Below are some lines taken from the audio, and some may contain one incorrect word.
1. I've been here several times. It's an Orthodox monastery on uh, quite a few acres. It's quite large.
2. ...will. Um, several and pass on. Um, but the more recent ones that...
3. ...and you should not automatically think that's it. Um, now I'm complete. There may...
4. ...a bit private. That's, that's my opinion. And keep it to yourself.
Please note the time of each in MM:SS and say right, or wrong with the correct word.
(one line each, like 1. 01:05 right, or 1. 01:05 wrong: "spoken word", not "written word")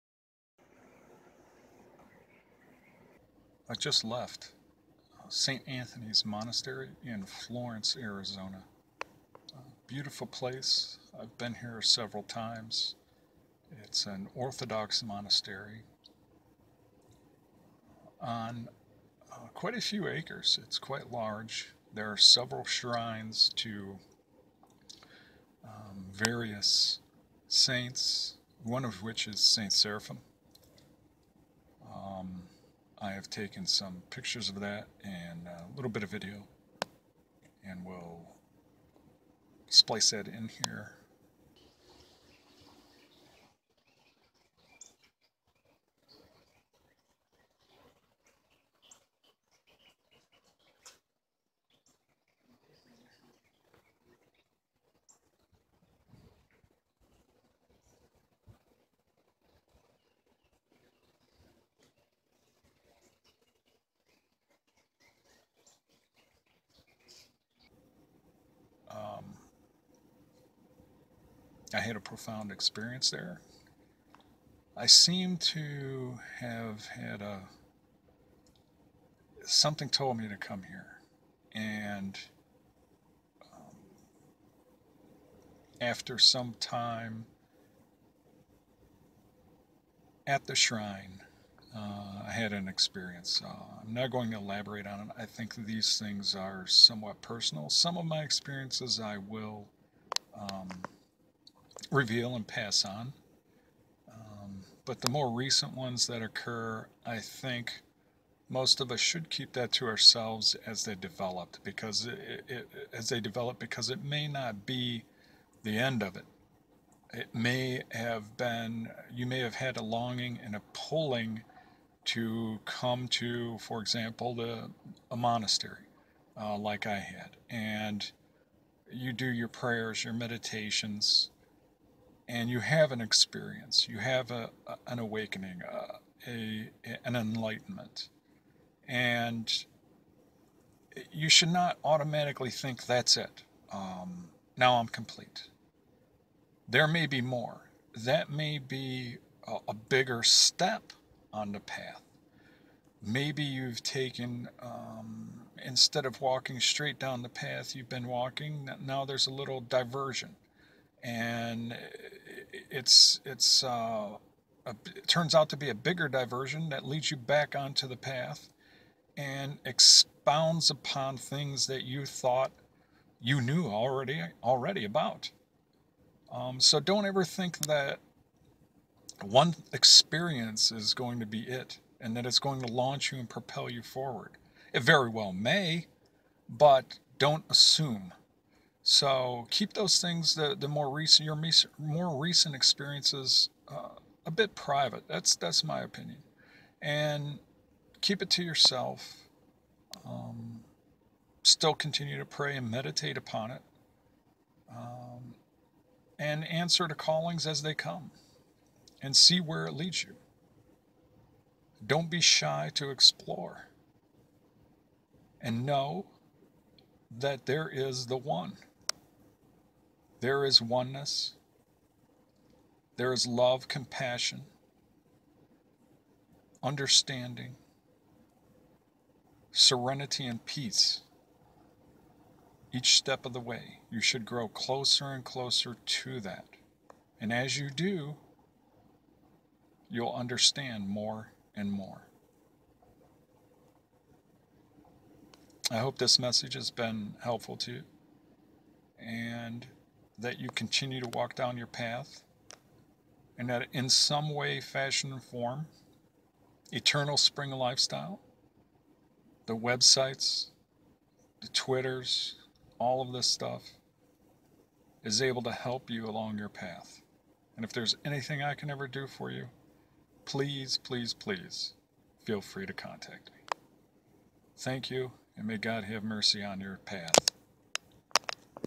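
1. 00:11 right
2. 01:39 wrong: "reveal", not "several"
3. 02:18 right
4. 03:14 right.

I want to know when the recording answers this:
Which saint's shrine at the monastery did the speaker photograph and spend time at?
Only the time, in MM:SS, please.
00:29.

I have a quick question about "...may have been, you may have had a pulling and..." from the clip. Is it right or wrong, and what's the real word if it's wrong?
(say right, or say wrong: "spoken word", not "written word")
wrong: "longing", not "pulling".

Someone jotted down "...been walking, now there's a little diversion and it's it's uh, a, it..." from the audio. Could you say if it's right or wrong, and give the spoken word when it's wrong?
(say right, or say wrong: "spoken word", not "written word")
right.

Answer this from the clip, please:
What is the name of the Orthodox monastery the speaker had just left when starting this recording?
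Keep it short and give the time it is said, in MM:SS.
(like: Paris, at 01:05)
St. Anthony's Monastery, at 00:05.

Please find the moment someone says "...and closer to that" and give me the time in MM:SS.
03:55.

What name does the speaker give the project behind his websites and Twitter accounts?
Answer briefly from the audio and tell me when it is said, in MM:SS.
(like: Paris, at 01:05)
Eternal Spring Lifestyle, at 04:16.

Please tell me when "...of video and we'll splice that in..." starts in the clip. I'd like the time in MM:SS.
00:36.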